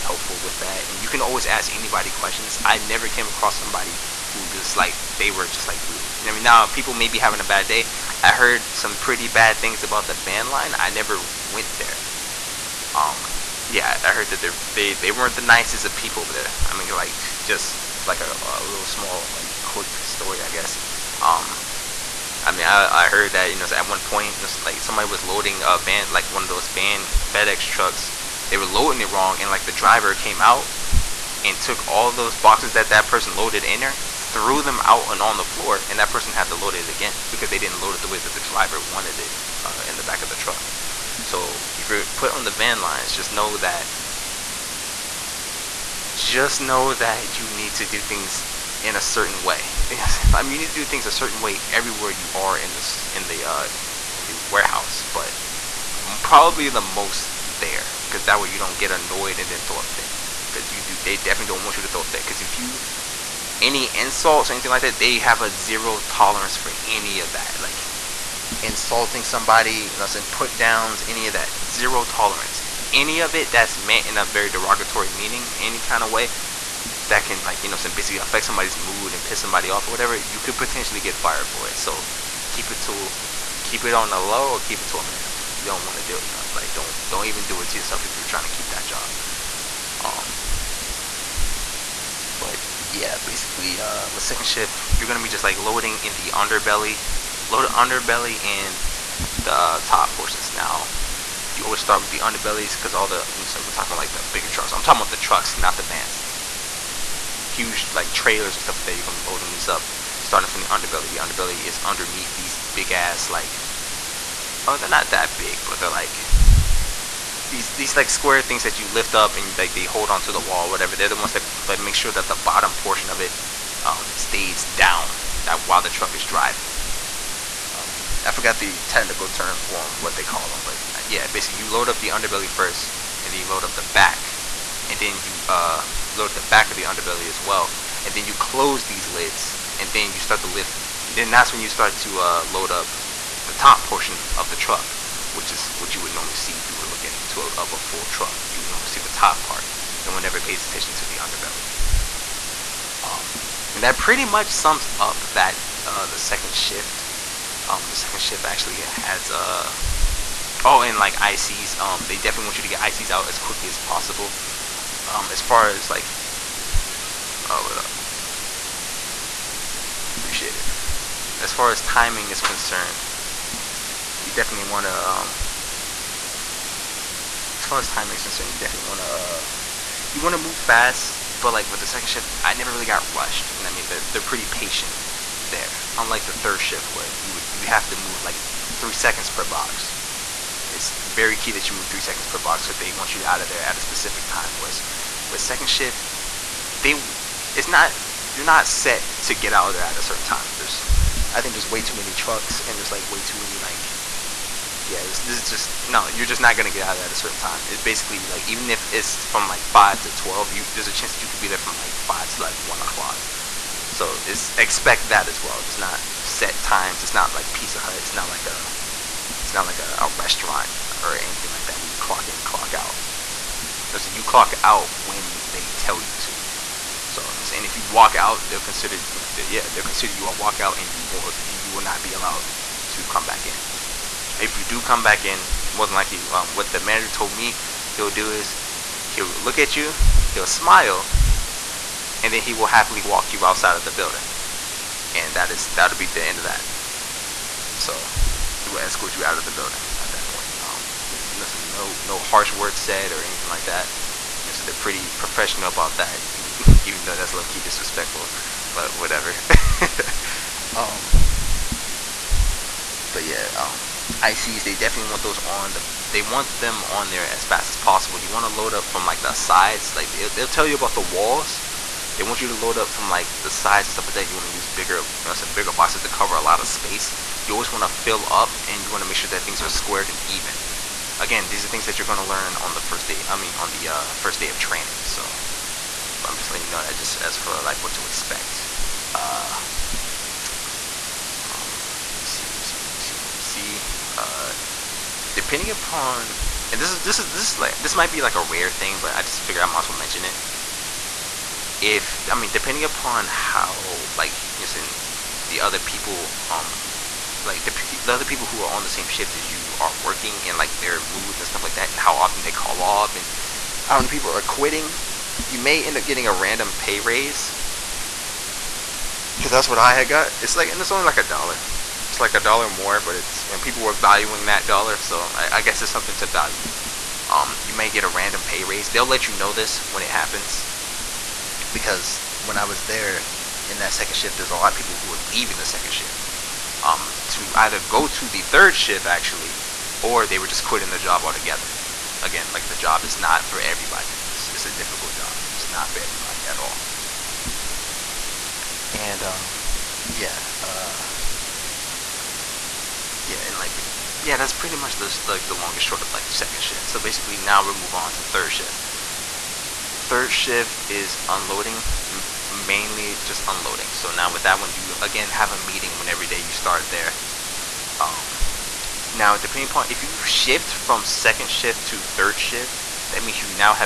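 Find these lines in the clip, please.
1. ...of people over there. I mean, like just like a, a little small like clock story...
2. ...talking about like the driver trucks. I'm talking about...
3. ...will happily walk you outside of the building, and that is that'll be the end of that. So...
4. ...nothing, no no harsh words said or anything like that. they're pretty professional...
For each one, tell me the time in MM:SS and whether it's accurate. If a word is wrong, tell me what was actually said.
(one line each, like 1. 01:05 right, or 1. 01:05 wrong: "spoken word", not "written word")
1. 00:15 wrong: "quick", not "clock"
2. 01:43 wrong: "bigger", not "driver"
3. 04:02 right
4. 04:11 right.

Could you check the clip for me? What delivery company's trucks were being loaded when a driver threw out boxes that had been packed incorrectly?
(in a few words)
FedEx.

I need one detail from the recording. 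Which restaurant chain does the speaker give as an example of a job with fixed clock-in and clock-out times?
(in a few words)
Pizza Hut.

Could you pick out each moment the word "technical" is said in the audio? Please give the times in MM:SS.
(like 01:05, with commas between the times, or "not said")
02:08.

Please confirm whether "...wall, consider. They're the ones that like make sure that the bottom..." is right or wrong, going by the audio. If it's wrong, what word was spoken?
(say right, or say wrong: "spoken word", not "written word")
wrong: "whatever", not "consider".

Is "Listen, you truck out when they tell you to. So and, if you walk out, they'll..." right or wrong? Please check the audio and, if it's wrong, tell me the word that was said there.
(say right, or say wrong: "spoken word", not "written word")
wrong: "clock", not "truck".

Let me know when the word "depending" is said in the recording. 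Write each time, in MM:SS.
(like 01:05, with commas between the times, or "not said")
04:55, 05:02, 06:09.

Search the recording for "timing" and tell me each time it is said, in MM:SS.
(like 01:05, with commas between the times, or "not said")
02:51, 02:57.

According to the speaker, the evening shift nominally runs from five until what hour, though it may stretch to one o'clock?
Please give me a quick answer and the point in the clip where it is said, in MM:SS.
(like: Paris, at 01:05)
12, at 03:30.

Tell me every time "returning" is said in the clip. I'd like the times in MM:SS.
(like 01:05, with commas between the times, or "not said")
not said.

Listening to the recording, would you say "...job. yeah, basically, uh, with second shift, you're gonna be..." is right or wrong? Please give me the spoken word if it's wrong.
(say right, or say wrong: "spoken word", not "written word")
right.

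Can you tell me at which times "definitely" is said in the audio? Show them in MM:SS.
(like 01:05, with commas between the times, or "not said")
01:01, 02:42, 02:54, 02:58, 04:24.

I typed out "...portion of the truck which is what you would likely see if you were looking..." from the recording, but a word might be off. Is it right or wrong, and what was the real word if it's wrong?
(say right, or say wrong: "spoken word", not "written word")
wrong: "normally", not "likely".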